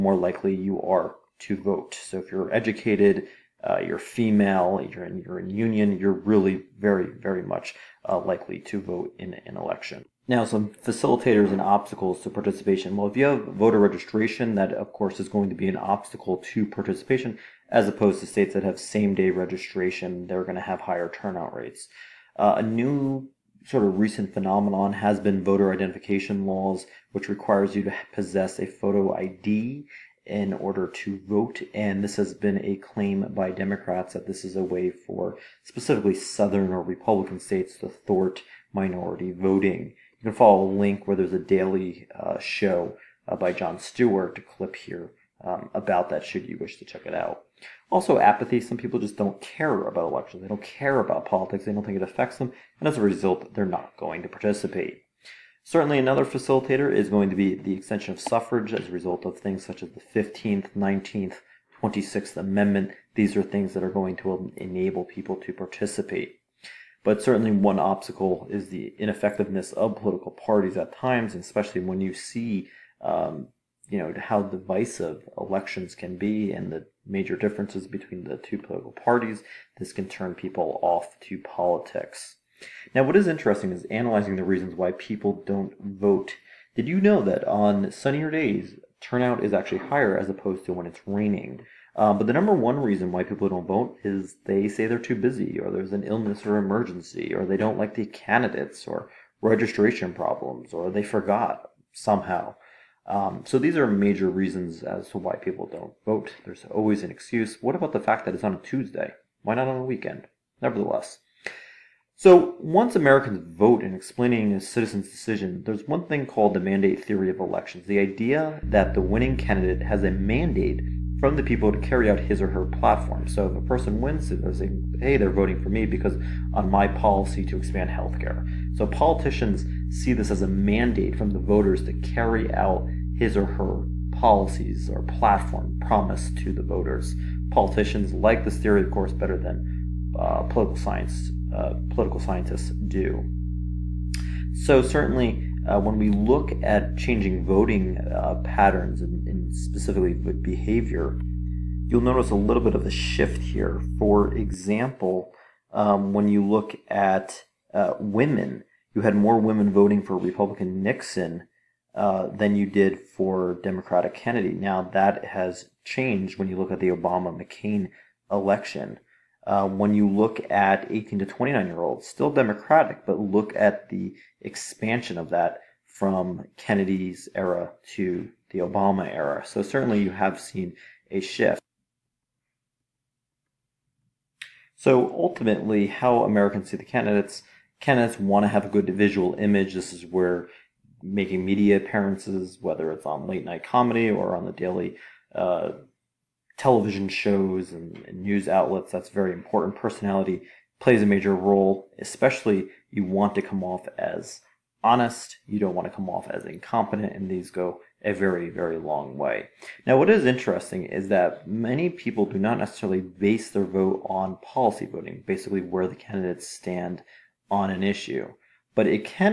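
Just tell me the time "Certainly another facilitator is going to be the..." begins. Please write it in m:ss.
0:55.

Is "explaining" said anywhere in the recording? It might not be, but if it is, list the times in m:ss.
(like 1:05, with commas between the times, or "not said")
1:53.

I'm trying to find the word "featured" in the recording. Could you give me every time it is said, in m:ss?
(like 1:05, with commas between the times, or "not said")
not said.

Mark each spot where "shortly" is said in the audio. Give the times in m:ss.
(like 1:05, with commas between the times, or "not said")
not said.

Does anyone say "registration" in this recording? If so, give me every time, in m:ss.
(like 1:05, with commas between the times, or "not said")
0:13, 0:19, 1:39.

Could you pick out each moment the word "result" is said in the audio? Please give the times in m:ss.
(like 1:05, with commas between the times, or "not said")
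0:53, 0:58.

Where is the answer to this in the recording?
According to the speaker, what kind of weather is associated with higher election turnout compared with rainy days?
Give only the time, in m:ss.
1:27.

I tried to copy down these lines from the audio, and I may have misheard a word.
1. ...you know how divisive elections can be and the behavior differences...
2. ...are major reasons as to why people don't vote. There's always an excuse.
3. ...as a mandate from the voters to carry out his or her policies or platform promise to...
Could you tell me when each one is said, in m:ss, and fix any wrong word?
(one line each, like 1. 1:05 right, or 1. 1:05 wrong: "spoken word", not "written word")
1. 1:13 wrong: "major", not "behavior"
2. 1:43 right
3. 2:10 right.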